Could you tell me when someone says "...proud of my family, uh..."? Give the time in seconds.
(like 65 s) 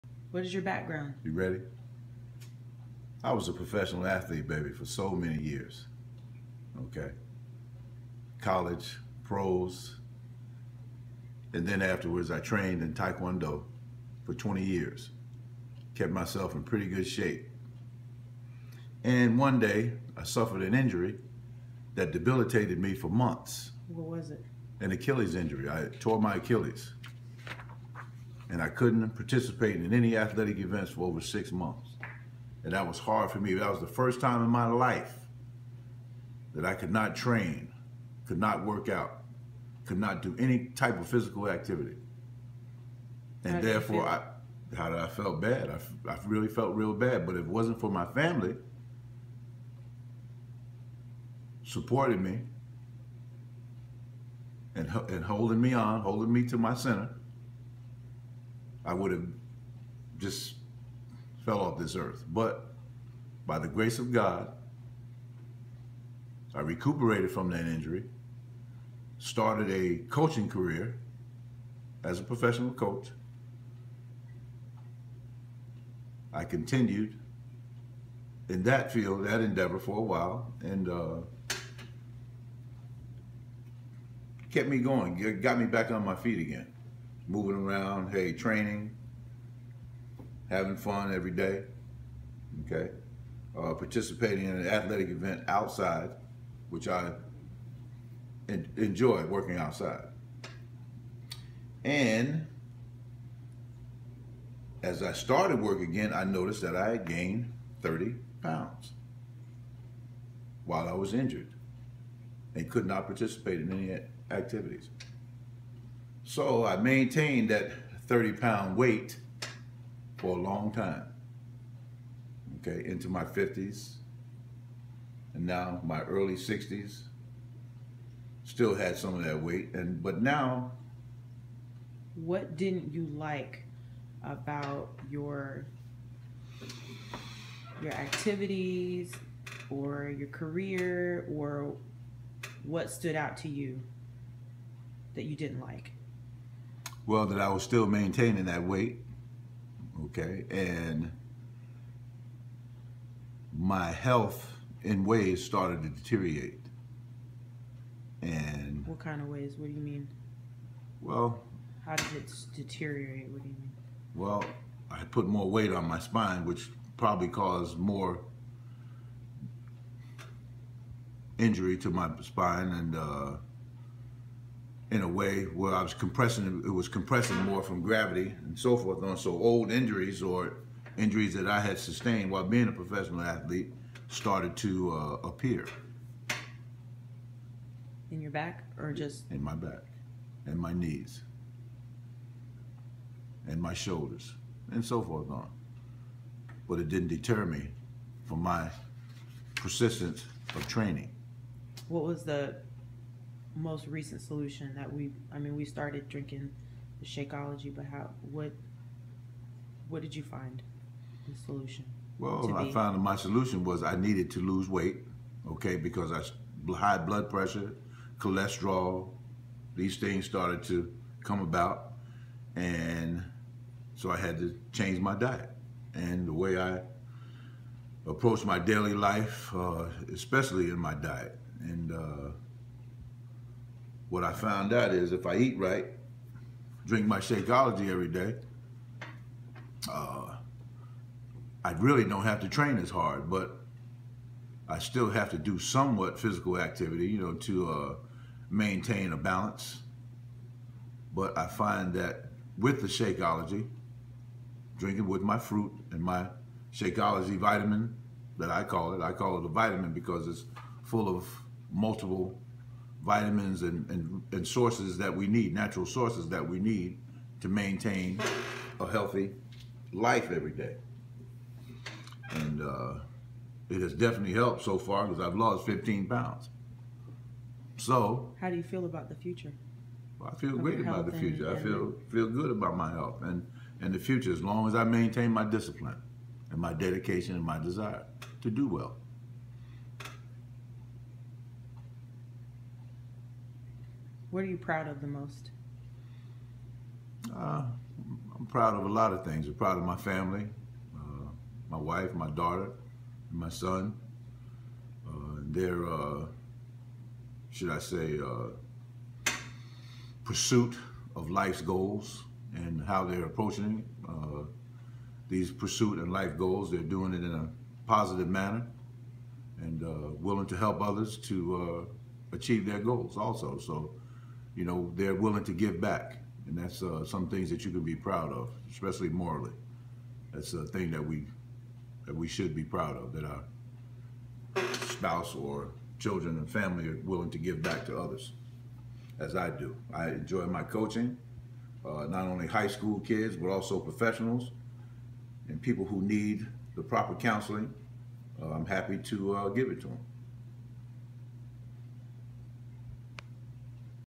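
299 s.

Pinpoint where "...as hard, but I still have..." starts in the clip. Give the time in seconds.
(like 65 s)
242 s.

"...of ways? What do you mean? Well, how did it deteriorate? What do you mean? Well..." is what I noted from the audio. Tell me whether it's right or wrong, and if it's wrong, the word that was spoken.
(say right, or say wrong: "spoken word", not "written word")
right.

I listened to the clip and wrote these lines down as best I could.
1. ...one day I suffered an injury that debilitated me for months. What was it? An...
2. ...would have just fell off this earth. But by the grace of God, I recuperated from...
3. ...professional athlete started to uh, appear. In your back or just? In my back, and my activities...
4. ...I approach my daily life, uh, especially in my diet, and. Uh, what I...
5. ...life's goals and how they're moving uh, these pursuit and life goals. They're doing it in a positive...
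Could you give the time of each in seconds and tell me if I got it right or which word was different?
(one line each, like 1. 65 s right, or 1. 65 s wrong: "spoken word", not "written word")
1. 19 s right
2. 58 s right
3. 182 s wrong: "knees", not "activities"
4. 226 s right
5. 311 s wrong: "approaching", not "moving".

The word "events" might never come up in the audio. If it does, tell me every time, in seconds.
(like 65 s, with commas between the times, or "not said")
30 s, 95 s.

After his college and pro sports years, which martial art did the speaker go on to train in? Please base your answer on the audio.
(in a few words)
Taekwondo.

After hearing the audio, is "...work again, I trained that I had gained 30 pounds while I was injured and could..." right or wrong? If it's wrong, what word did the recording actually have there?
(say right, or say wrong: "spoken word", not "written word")
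wrong: "noticed", not "trained".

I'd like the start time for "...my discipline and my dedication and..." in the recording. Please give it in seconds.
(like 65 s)
285 s.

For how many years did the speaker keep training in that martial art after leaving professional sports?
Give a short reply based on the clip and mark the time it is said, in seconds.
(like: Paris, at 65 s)
20 years, at 14 s.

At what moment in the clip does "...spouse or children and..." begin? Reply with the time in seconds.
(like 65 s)
334 s.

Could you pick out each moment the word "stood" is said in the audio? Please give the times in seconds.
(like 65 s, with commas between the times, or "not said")
142 s.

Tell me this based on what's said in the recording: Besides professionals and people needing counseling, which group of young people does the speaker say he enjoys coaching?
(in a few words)
High school kids.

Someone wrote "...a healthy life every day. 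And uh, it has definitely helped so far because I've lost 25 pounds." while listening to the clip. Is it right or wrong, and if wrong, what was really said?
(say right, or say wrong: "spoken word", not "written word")
wrong: "15", not "25".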